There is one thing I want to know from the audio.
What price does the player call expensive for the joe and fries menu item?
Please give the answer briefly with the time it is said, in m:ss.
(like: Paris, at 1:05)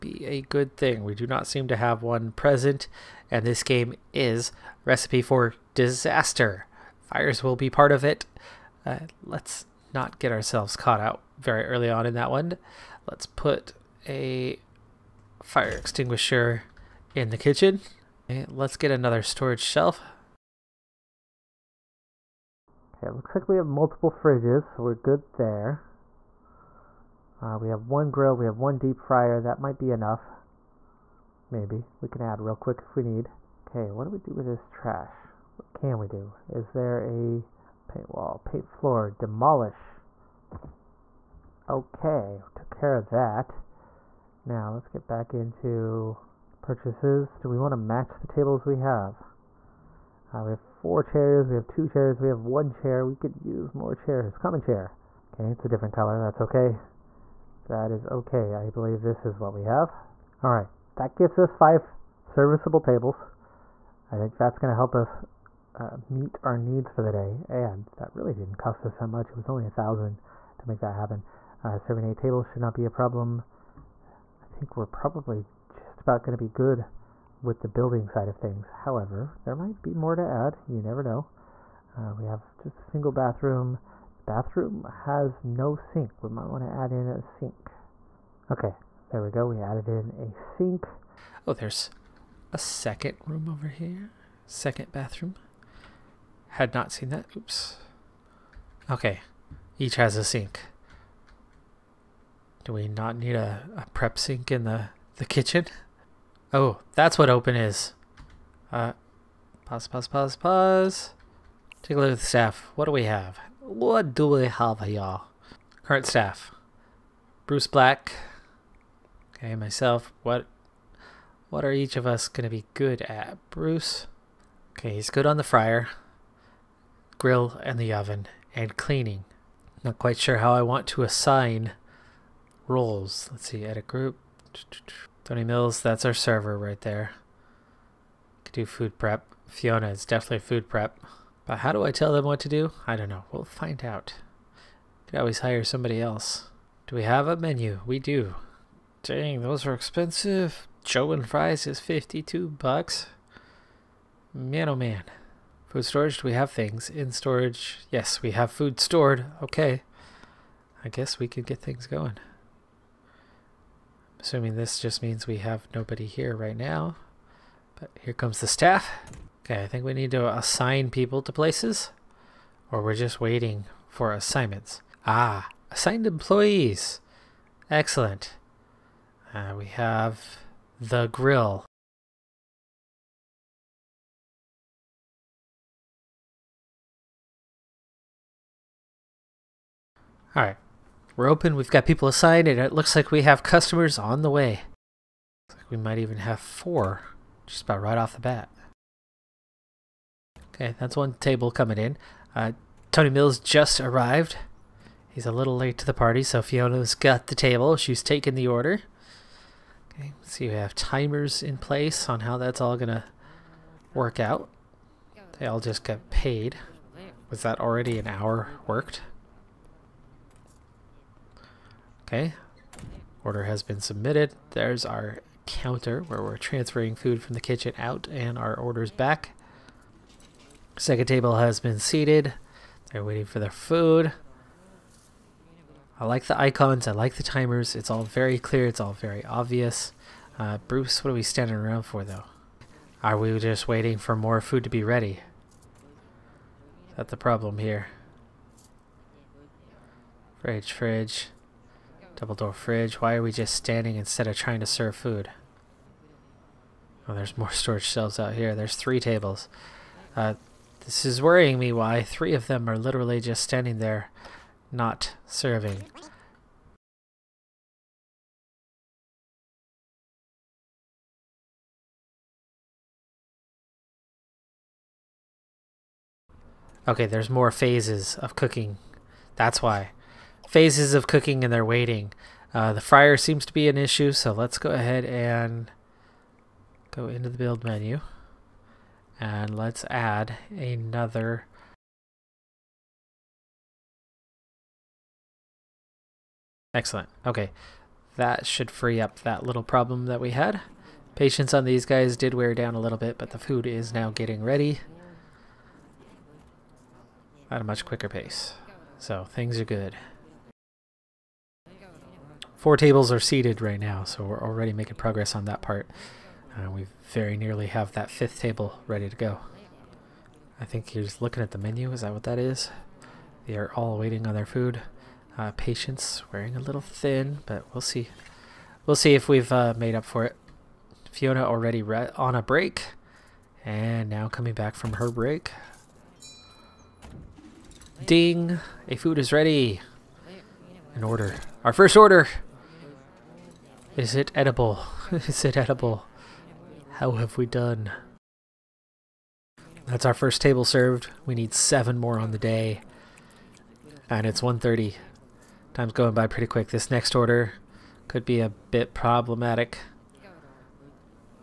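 52 bucks, at 2:31.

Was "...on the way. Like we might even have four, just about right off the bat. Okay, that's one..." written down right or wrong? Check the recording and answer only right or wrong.
right.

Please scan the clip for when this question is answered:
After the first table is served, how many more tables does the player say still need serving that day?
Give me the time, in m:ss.
5:51.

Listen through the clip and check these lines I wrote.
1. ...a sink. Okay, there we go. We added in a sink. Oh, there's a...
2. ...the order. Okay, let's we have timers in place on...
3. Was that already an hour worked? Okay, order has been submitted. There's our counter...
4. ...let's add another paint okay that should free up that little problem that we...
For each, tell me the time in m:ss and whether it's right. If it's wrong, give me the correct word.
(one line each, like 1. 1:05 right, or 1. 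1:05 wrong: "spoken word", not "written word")
1. 1:27 right
2. 3:28 right
3. 3:37 right
4. 4:49 wrong: "excellent", not "paint".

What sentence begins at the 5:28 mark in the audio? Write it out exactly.
We'll see if we've uh, made up for it.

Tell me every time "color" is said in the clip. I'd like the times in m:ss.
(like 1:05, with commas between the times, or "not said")
0:55.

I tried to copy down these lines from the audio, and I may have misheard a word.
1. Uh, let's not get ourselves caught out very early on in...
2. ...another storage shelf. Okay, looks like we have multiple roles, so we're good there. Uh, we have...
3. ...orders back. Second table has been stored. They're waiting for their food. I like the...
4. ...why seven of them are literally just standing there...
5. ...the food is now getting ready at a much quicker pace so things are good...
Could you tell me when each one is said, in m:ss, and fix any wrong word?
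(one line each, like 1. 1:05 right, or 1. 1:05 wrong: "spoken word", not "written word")
1. 0:08 right
2. 0:18 wrong: "fridges", not "roles"
3. 3:48 wrong: "seated", not "stored"
4. 4:21 wrong: "three", not "seven"
5. 5:03 right.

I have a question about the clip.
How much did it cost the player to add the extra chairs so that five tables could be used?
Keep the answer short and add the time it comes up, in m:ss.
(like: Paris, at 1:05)
1000, at 1:09.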